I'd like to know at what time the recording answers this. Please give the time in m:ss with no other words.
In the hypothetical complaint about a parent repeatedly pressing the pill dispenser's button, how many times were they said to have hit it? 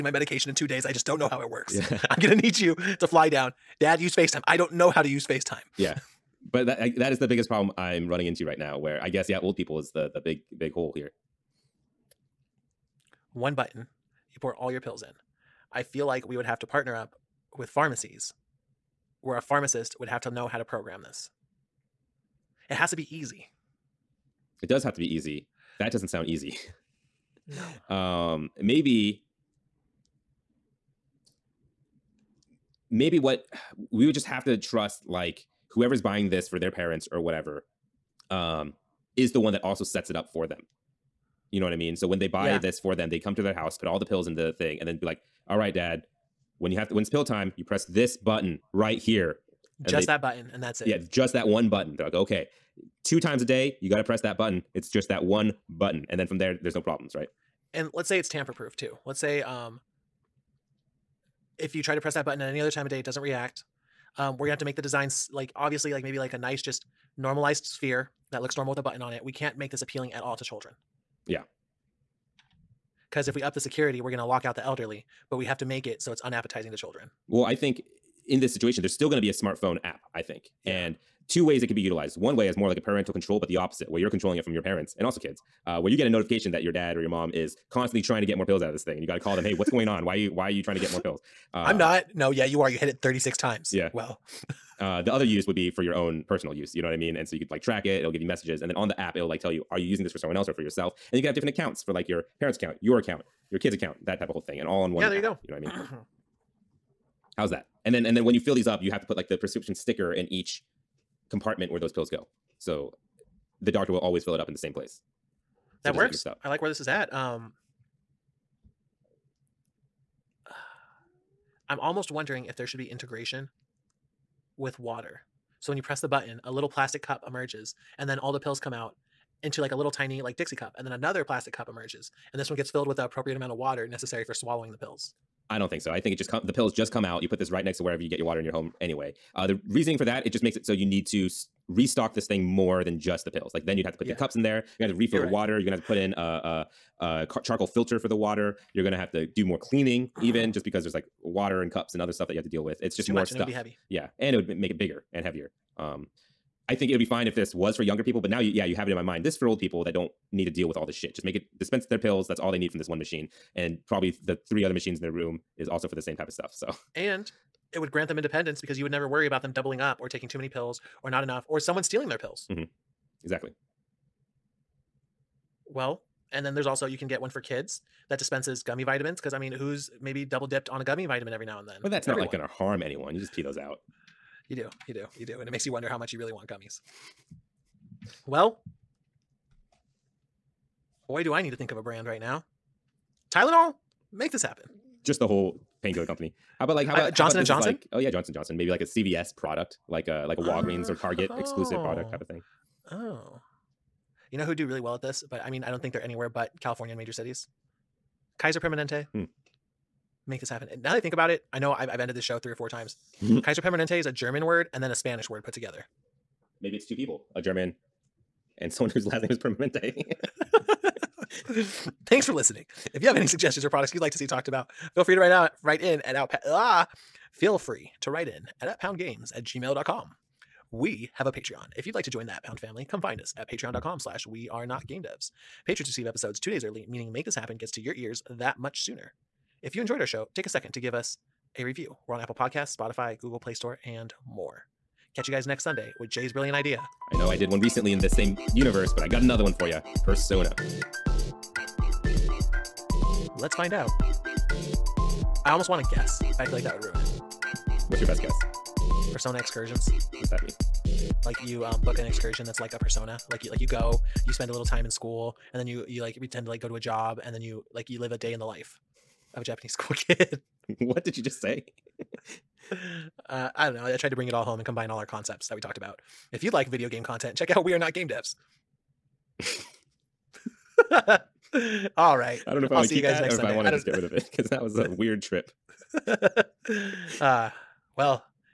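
1:33.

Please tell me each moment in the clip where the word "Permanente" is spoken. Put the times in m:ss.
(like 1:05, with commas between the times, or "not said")
3:28, 3:33, 3:39.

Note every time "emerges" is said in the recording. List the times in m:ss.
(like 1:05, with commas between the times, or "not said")
2:07, 2:11.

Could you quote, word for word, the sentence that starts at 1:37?
And so you could like track it.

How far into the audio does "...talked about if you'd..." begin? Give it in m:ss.
4:35.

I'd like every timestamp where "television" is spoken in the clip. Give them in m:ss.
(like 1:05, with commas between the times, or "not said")
not said.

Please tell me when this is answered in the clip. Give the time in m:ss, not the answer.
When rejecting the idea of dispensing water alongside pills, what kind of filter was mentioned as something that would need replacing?
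2:27.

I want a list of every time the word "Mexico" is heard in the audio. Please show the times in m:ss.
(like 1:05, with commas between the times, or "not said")
not said.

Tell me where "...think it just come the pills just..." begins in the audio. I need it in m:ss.
2:15.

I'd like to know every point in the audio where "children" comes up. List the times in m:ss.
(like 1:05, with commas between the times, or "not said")
1:10, 1:16.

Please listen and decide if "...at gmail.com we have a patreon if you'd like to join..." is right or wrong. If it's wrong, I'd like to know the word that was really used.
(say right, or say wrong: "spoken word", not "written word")
right.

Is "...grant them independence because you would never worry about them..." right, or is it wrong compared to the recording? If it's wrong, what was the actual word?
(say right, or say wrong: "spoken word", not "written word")
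right.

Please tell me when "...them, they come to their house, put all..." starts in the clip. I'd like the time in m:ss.
0:42.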